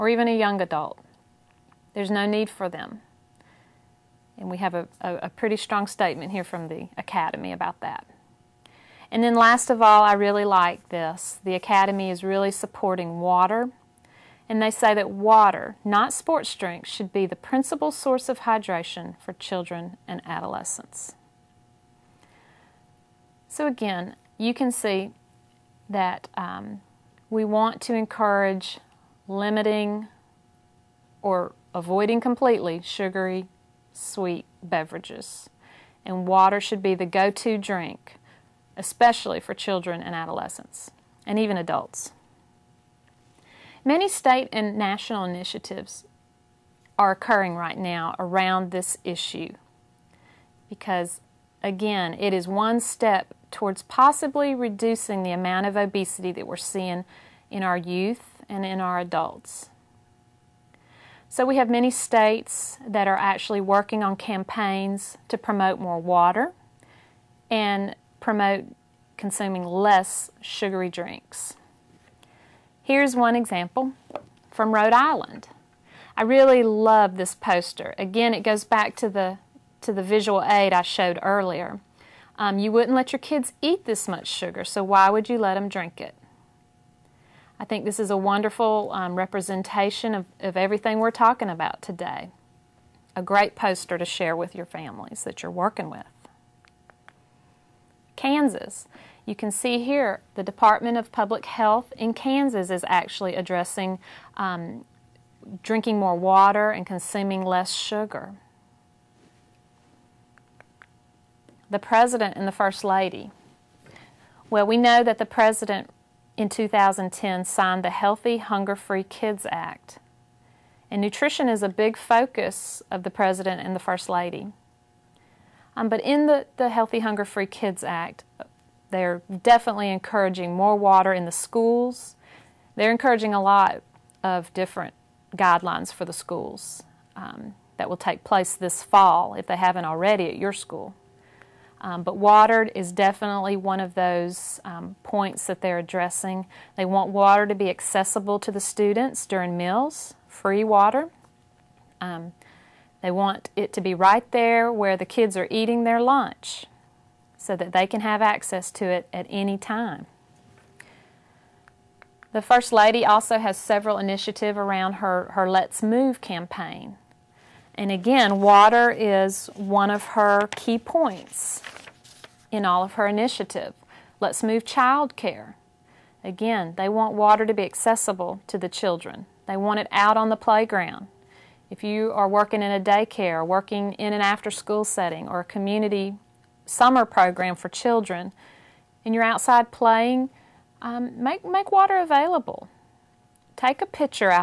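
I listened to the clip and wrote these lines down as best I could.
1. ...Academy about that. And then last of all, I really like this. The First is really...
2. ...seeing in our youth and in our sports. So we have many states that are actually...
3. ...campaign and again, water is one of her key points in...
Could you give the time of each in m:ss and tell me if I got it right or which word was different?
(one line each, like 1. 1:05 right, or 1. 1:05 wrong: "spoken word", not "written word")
1. 0:06 wrong: "Academy", not "First"
2. 0:56 wrong: "adults", not "sports"
3. 2:46 right.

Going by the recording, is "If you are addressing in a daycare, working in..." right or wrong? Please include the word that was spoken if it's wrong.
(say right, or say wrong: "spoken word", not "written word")
wrong: "working", not "addressing".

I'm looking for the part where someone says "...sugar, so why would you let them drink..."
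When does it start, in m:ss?
1:24.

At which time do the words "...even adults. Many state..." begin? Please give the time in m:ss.
0:41.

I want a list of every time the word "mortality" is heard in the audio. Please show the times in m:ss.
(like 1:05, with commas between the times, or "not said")
not said.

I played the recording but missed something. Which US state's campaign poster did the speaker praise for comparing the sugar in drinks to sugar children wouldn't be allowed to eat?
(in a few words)
Rhode Island.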